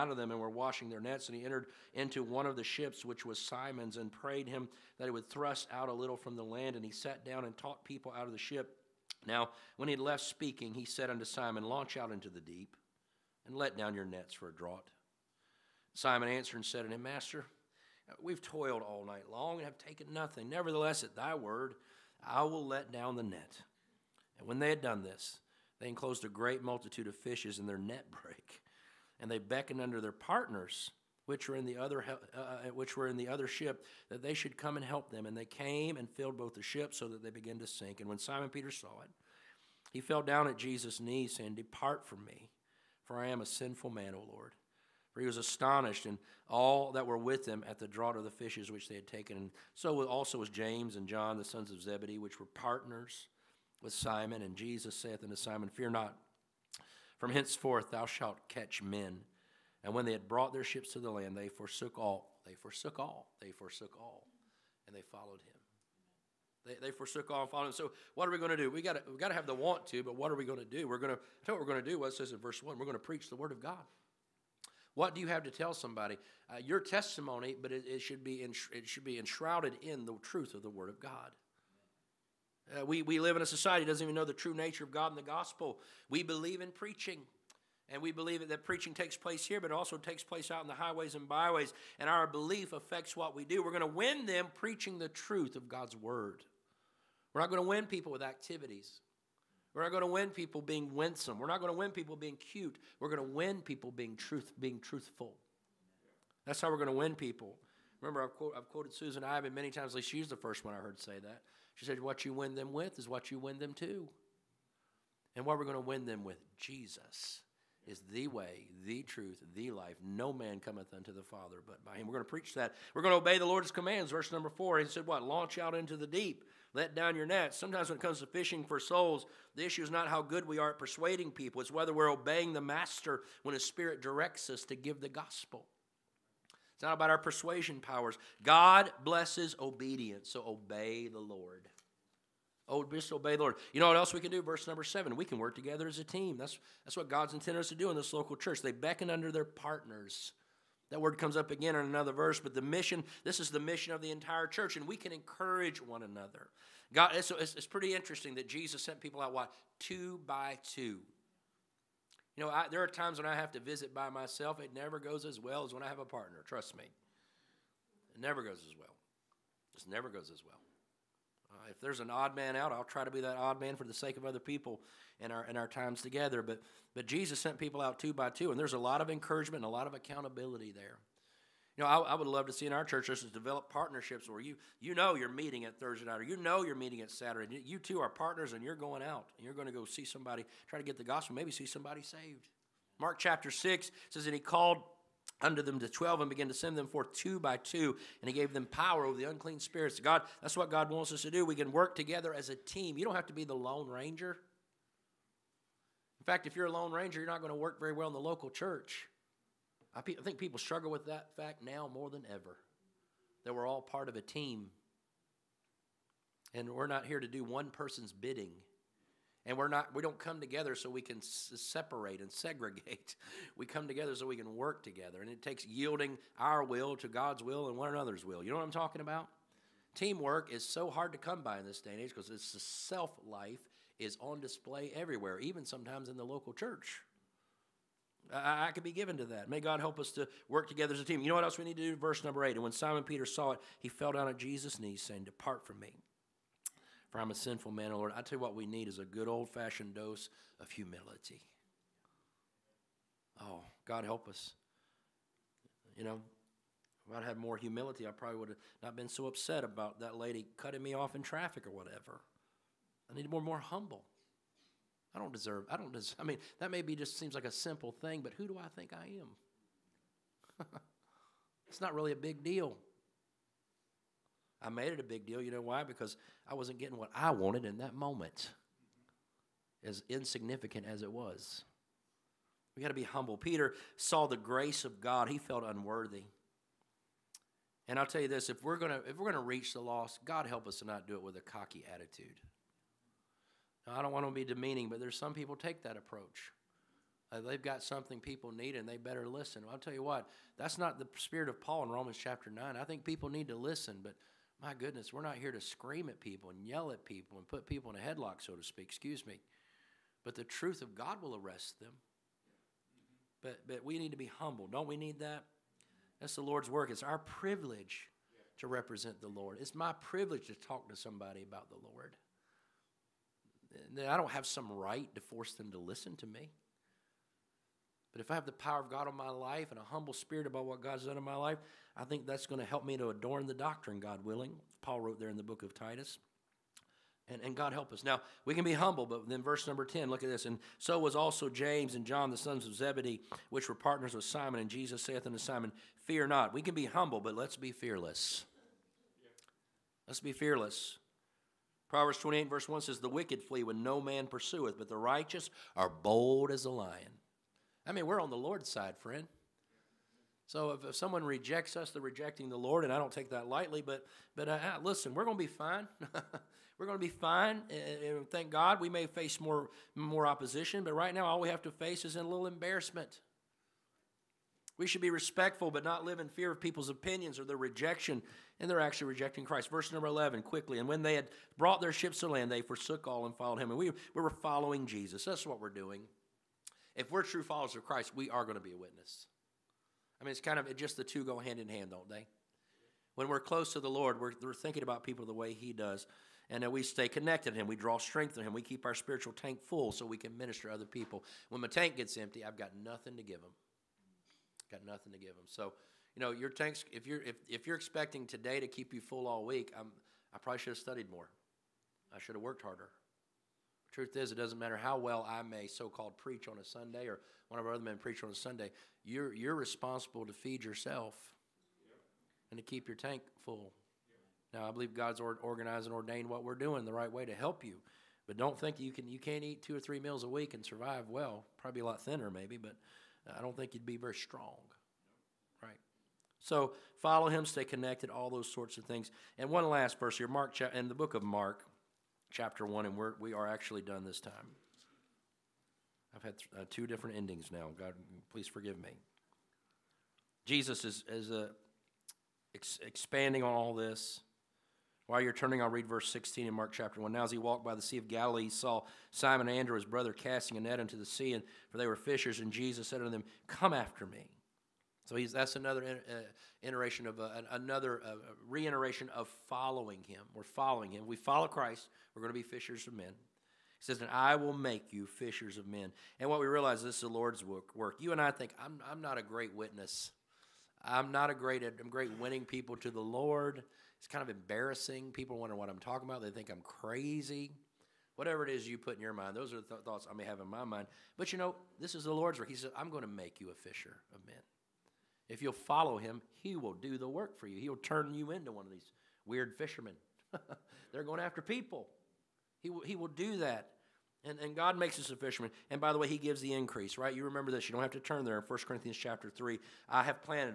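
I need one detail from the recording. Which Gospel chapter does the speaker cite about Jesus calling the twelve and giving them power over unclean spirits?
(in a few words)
Mark chapter 6.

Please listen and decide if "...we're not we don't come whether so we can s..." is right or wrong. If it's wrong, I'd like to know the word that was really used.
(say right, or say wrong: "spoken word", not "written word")
wrong: "together", not "whether".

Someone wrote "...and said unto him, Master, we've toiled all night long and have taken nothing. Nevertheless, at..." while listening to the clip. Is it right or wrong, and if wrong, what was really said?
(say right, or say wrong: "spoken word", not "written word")
right.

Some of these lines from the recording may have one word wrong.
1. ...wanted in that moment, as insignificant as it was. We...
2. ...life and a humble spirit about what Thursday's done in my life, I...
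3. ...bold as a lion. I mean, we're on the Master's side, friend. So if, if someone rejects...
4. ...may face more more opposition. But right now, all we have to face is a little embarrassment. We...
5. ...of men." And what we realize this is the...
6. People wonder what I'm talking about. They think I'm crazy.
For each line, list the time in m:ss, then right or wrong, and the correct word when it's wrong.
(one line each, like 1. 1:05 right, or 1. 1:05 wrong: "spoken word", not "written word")
1. 4:37 right
2. 5:29 wrong: "God", not "Thursday"
3. 5:55 wrong: "Lord", not "Master"
4. 6:08 right
5. 7:55 right
6. 8:05 right.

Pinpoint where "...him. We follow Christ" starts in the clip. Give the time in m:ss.
7:50.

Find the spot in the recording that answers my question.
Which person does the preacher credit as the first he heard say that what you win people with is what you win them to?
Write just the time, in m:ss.
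1:48.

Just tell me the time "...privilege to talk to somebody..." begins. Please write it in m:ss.
5:20.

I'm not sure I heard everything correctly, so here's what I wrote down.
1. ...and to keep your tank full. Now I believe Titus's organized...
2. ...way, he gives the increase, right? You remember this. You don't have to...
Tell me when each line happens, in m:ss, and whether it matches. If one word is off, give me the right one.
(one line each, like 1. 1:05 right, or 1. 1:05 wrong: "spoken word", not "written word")
1. 7:02 wrong: "God", not "Titus"
2. 8:25 right.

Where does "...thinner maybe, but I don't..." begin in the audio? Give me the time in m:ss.
7:12.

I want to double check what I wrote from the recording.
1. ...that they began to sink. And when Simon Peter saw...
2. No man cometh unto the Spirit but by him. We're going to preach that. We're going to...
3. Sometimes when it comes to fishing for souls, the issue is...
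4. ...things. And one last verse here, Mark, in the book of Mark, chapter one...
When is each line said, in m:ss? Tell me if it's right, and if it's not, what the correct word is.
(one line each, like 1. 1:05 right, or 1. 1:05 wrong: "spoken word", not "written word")
1. 0:37 right
2. 2:00 wrong: "Father", not "Spirit"
3. 2:07 right
4. 7:18 right.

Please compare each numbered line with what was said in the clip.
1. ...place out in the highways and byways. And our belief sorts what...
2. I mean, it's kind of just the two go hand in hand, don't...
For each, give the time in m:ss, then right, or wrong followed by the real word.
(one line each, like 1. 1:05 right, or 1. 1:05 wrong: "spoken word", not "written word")
1. 1:30 wrong: "affects", not "sorts"
2. 6:30 right.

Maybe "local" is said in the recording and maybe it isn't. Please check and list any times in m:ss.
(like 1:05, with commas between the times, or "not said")
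2:28, 3:28, 3:56.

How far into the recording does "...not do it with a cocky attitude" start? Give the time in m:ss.
4:50.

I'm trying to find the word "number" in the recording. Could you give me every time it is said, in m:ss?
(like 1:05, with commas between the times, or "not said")
2:04, 2:24, 4:02, 5:39, 6:19.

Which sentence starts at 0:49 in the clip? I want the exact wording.
And so also was James and John, the sons of Zebedee, which were partners with Simon.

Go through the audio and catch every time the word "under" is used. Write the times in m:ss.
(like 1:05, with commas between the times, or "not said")
2:29, 3:15.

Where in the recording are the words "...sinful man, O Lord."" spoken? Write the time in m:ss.
0:43.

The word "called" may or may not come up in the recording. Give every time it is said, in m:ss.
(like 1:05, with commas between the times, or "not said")
3:14, 6:55.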